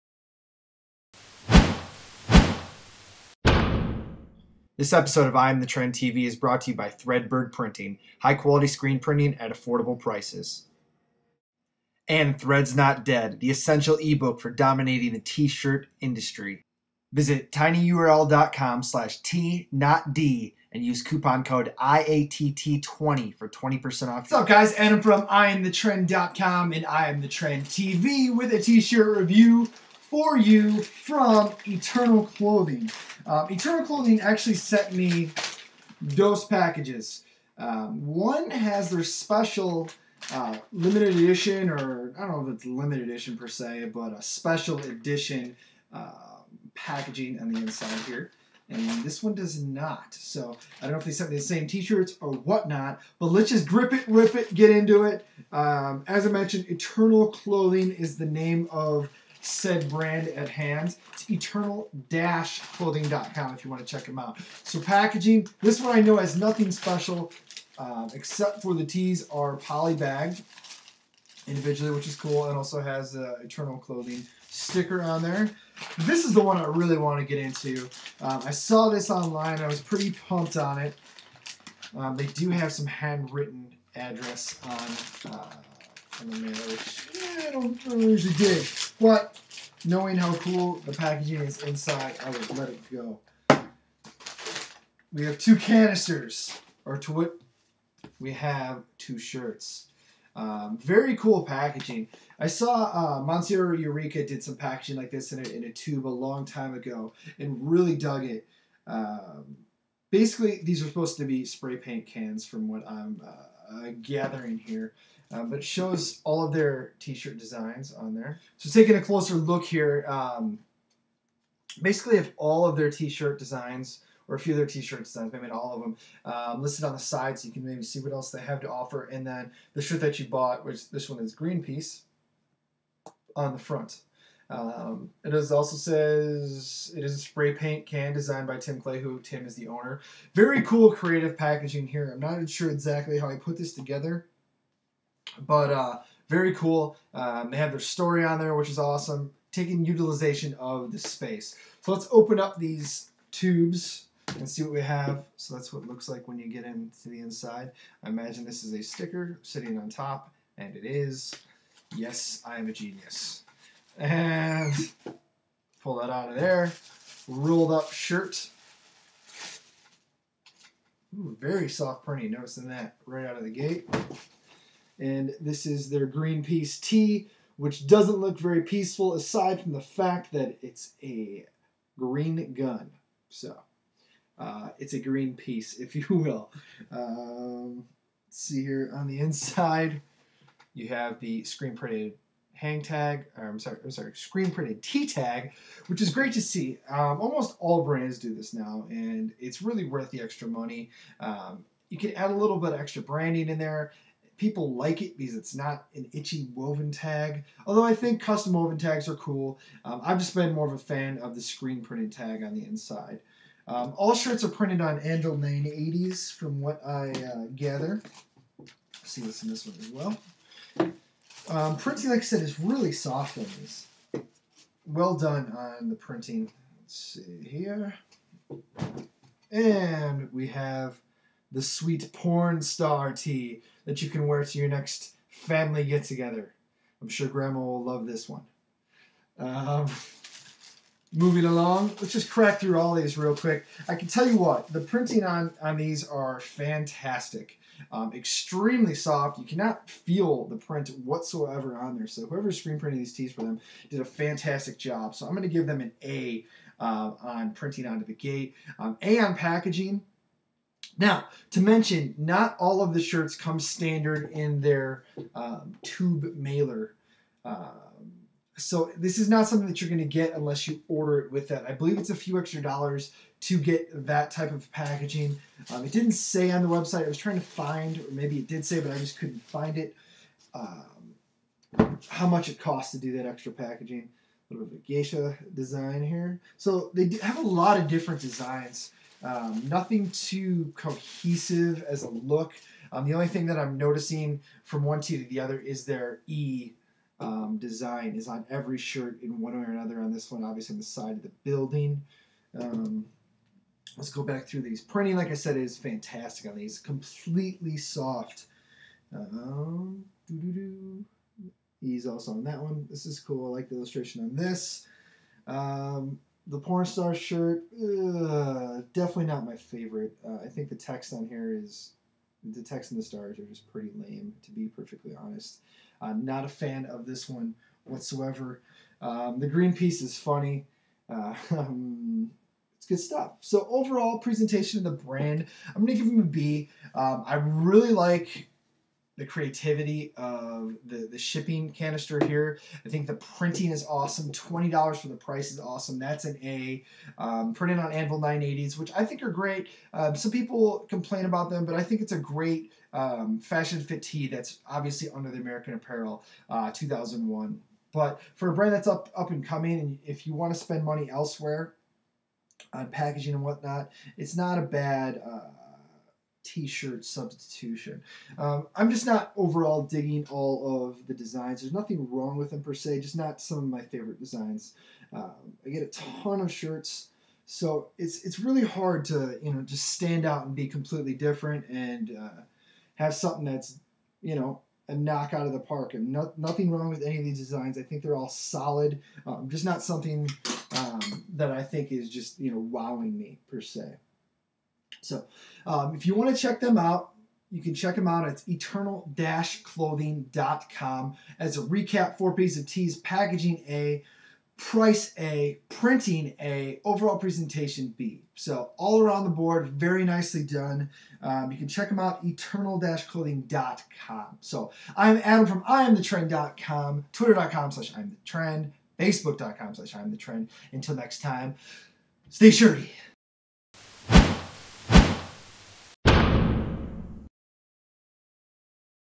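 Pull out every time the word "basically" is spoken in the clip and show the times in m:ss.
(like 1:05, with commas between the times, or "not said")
1:50, 2:01.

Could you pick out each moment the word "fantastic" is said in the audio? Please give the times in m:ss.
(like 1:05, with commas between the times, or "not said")
4:06, 4:14, 5:05.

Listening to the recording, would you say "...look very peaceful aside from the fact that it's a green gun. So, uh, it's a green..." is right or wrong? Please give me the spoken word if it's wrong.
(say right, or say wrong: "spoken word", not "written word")
right.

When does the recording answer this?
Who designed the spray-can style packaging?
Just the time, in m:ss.
2:18.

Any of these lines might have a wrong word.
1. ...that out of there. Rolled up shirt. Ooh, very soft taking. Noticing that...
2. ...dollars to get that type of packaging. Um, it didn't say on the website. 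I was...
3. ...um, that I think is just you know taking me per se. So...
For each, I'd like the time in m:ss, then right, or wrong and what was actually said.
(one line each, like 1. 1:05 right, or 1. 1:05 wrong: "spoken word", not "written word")
1. 2:45 wrong: "printing", not "taking"
2. 4:32 right
3. 6:30 wrong: "wowing", not "taking".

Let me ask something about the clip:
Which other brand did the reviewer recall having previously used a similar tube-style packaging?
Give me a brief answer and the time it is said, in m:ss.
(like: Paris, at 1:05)
Monsieur Eureka, at 1:43.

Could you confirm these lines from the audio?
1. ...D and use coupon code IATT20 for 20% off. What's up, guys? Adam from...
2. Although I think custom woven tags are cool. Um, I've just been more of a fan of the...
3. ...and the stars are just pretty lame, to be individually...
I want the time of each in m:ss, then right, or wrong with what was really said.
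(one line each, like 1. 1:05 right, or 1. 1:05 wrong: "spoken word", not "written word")
1. 0:20 right
2. 3:27 right
3. 5:22 wrong: "perfectly", not "individually".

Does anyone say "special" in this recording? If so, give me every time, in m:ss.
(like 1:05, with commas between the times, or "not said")
0:39, 0:44, 1:06.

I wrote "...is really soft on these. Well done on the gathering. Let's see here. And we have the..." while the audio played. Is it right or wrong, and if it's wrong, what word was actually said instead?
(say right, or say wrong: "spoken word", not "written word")
wrong: "printing", not "gathering".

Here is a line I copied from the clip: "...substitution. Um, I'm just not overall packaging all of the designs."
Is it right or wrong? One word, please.
wrong.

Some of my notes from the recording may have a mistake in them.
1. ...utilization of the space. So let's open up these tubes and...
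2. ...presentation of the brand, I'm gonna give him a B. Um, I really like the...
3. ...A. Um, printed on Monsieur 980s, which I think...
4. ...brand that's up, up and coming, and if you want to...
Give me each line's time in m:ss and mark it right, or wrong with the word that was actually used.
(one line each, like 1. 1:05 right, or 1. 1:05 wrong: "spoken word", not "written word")
1. 2:29 right
2. 5:34 right
3. 5:46 wrong: "Anvil", not "Monsieur"
4. 5:58 right.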